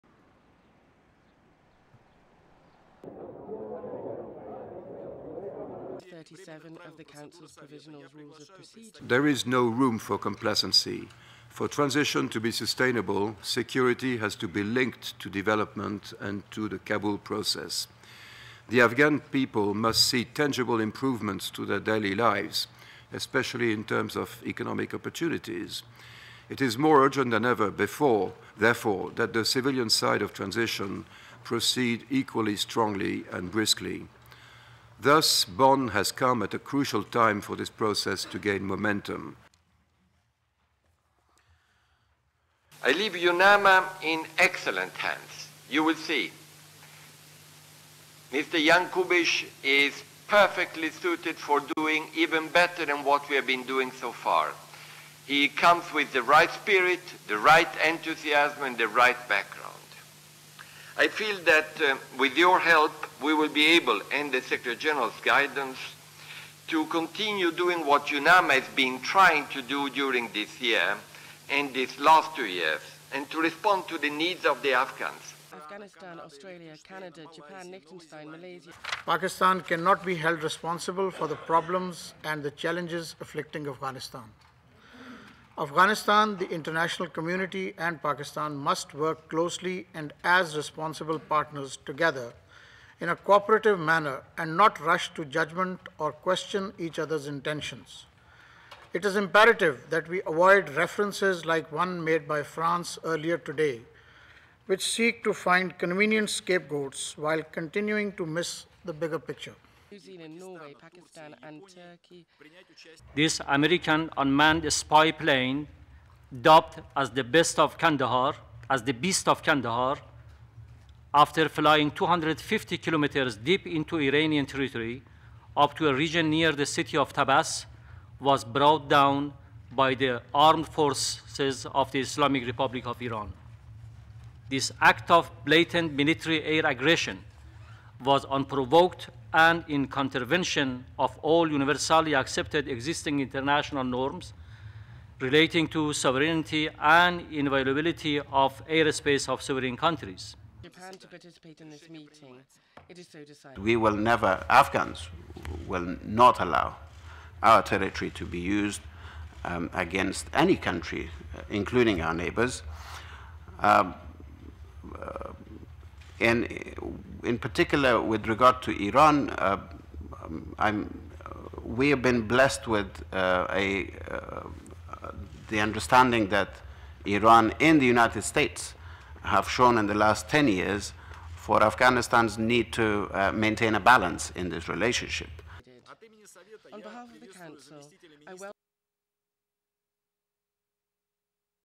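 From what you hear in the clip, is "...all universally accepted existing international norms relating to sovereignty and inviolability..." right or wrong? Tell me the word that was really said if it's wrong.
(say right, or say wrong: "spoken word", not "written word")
right.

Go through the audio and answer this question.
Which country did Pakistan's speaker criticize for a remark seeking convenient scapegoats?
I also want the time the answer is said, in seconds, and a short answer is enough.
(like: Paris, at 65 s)
France, at 102 s.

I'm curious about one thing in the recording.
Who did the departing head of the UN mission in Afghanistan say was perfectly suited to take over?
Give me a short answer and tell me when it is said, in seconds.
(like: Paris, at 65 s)
Mr. Jan, at 48 s.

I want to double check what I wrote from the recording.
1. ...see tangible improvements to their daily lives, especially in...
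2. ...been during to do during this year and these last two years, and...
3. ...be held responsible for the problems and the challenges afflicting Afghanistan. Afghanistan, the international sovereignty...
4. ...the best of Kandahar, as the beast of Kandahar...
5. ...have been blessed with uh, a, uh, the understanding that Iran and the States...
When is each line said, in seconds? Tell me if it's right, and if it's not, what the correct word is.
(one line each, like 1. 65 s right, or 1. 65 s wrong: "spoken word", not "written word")
1. 20 s right
2. 68 s wrong: "trying", not "during"
3. 80 s wrong: "community", not "sovereignty"
4. 117 s right
5. 171 s wrong: "United", not "States".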